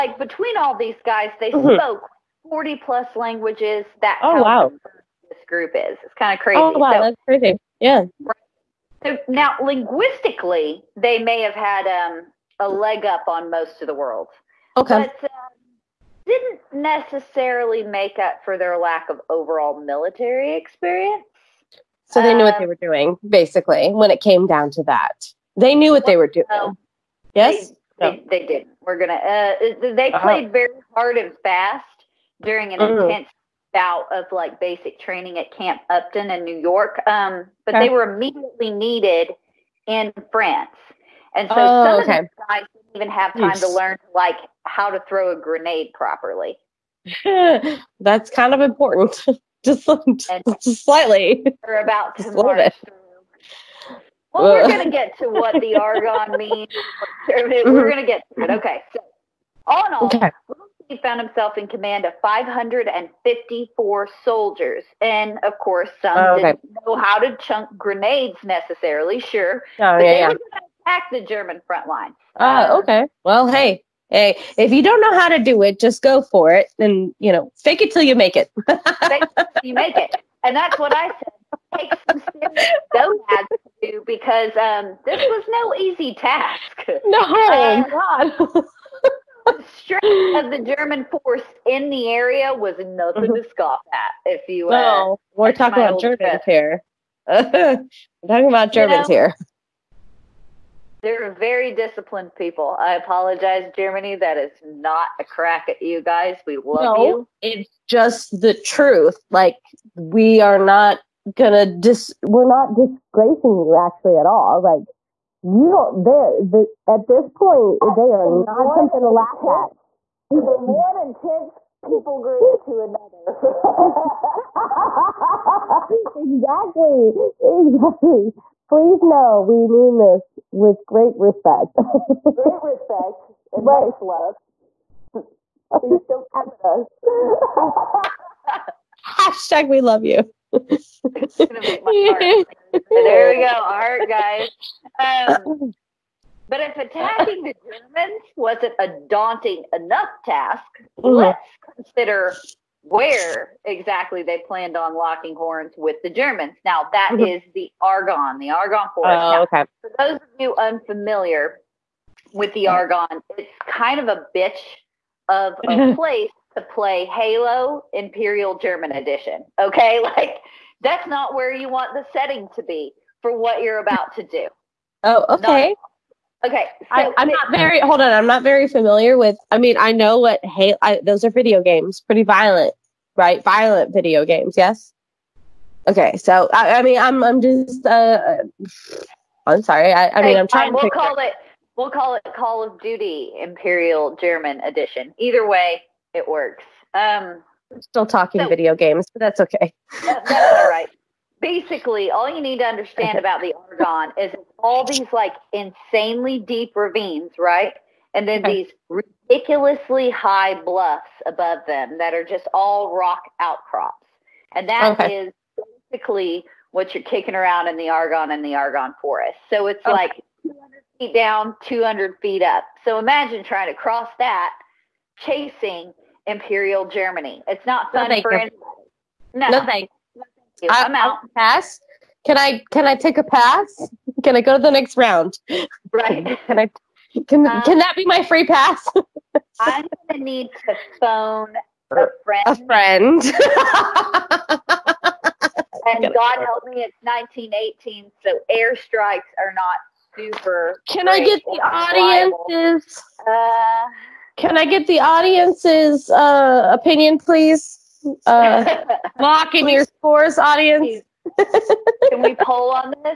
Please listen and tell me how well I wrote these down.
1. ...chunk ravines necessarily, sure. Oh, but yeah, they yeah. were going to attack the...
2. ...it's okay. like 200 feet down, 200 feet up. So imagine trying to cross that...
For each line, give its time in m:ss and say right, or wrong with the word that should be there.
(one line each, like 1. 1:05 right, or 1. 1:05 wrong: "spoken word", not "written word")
1. 1:07 wrong: "grenades", not "ravines"
2. 3:39 right.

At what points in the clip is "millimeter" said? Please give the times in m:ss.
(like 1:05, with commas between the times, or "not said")
not said.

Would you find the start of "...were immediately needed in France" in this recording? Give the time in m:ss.
0:37.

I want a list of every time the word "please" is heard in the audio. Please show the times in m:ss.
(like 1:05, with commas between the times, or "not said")
2:08, 2:15, 4:17.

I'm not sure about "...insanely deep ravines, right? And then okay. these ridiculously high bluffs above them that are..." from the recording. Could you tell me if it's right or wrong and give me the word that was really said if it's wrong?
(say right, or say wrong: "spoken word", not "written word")
right.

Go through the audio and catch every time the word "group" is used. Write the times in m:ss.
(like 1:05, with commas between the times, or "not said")
0:05, 2:02.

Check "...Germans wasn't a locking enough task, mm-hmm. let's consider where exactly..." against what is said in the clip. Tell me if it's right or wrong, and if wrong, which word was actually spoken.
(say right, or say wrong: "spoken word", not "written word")
wrong: "daunting", not "locking".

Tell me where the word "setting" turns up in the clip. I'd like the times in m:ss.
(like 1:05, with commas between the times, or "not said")
2:52.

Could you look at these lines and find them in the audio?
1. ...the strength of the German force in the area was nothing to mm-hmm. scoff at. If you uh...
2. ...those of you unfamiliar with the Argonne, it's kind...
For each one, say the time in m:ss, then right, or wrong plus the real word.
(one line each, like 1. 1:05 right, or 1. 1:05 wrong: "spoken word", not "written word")
1. 1:29 right
2. 2:39 right.